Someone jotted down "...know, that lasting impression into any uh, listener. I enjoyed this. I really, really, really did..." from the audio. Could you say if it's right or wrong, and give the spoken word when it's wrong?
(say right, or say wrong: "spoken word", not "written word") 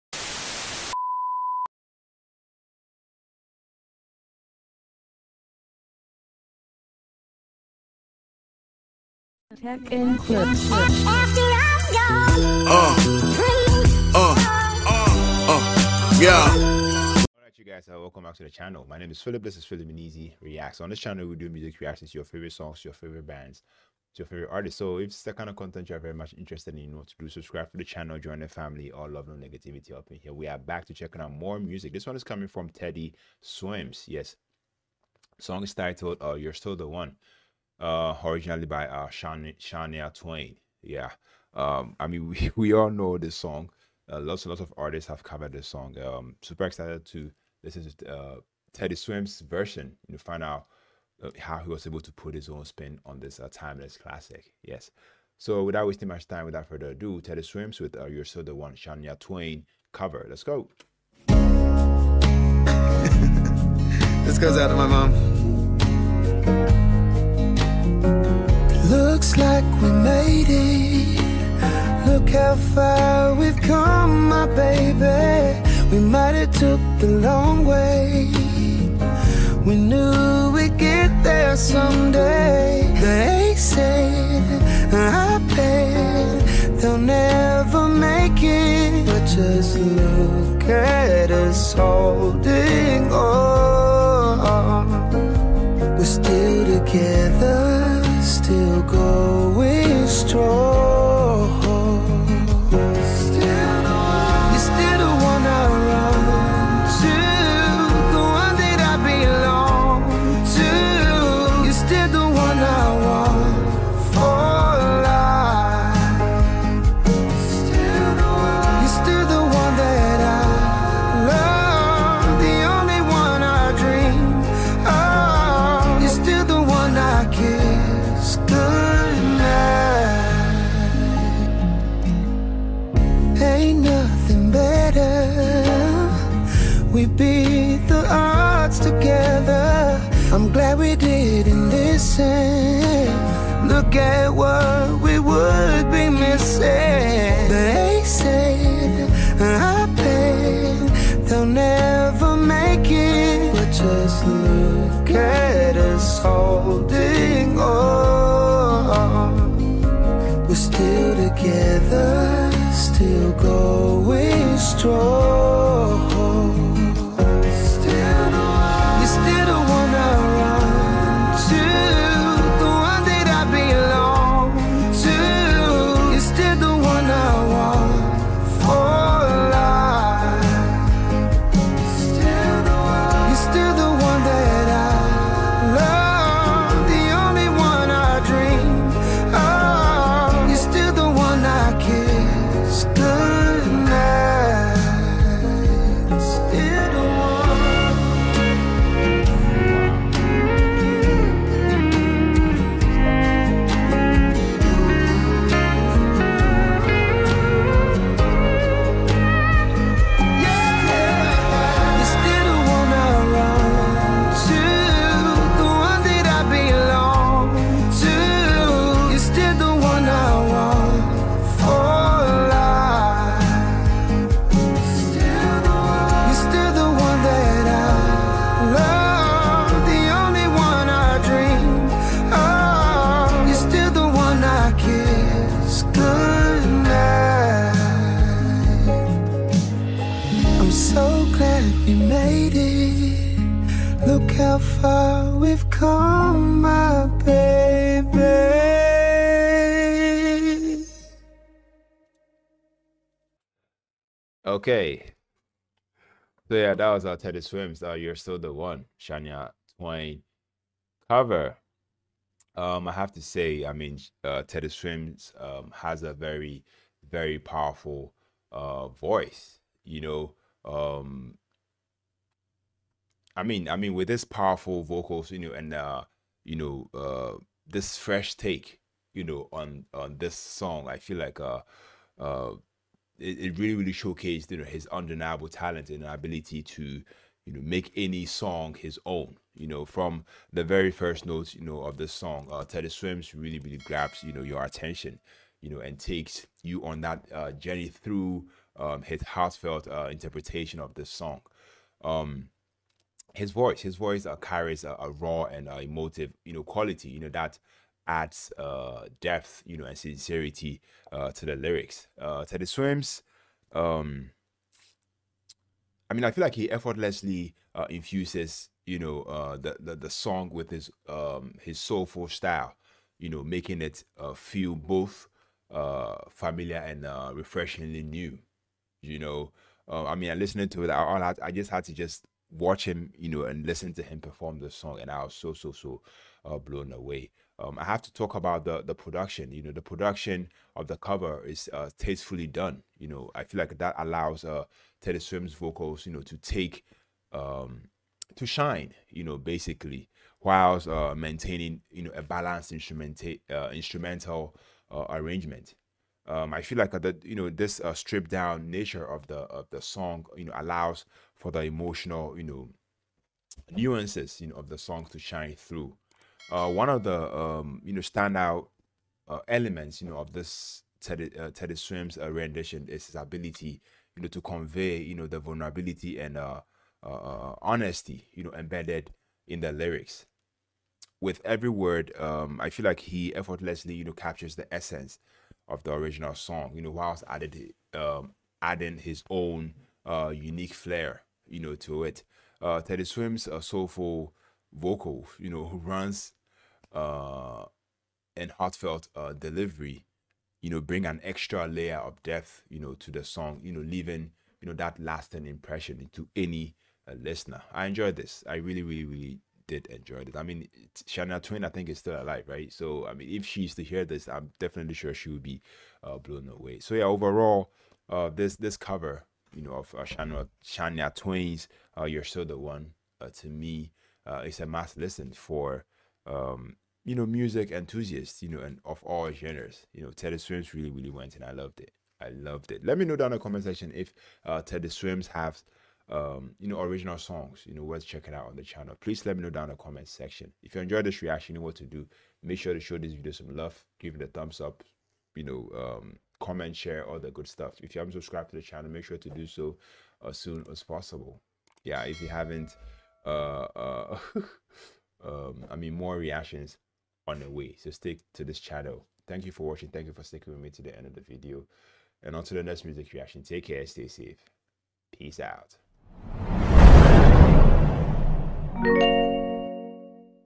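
right.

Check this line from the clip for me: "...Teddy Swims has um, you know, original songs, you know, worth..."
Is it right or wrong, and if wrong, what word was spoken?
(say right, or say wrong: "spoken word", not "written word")
right.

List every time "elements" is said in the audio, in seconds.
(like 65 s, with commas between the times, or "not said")
369 s.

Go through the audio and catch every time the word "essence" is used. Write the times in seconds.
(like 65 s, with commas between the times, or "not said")
384 s.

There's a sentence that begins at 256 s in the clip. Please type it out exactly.
So yeah, that was our Teddy Swims.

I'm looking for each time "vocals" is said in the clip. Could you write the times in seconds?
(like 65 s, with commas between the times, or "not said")
274 s, 345 s, 394 s.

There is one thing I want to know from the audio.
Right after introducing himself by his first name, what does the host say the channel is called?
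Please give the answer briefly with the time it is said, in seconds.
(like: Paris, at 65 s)
Philiminizzy Reacts, at 19 s.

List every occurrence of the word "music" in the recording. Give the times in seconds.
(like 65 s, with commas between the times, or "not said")
21 s, 31 s, 427 s, 462 s.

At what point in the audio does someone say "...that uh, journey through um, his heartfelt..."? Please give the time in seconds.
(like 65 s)
297 s.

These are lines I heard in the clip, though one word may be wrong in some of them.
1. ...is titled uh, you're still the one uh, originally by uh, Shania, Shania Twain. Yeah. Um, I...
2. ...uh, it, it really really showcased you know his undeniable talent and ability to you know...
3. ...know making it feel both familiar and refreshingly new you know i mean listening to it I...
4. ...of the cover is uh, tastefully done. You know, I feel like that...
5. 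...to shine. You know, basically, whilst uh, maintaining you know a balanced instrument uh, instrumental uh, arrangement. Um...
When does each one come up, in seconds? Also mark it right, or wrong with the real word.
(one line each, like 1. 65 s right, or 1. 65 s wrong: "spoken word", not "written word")
1. 35 s right
2. 282 s right
3. 323 s right
4. 340 s right
5. 348 s right.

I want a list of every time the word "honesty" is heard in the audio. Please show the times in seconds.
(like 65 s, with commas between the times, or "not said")
377 s.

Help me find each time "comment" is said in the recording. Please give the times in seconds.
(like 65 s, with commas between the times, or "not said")
433 s, 439 s, 446 s.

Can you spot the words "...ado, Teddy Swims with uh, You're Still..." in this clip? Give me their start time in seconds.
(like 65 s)
56 s.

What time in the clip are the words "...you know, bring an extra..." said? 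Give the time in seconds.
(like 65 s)
400 s.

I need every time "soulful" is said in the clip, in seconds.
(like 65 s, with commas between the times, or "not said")
321 s, 393 s.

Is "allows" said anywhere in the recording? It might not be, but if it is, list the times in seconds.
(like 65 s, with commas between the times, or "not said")
343 s, 360 s.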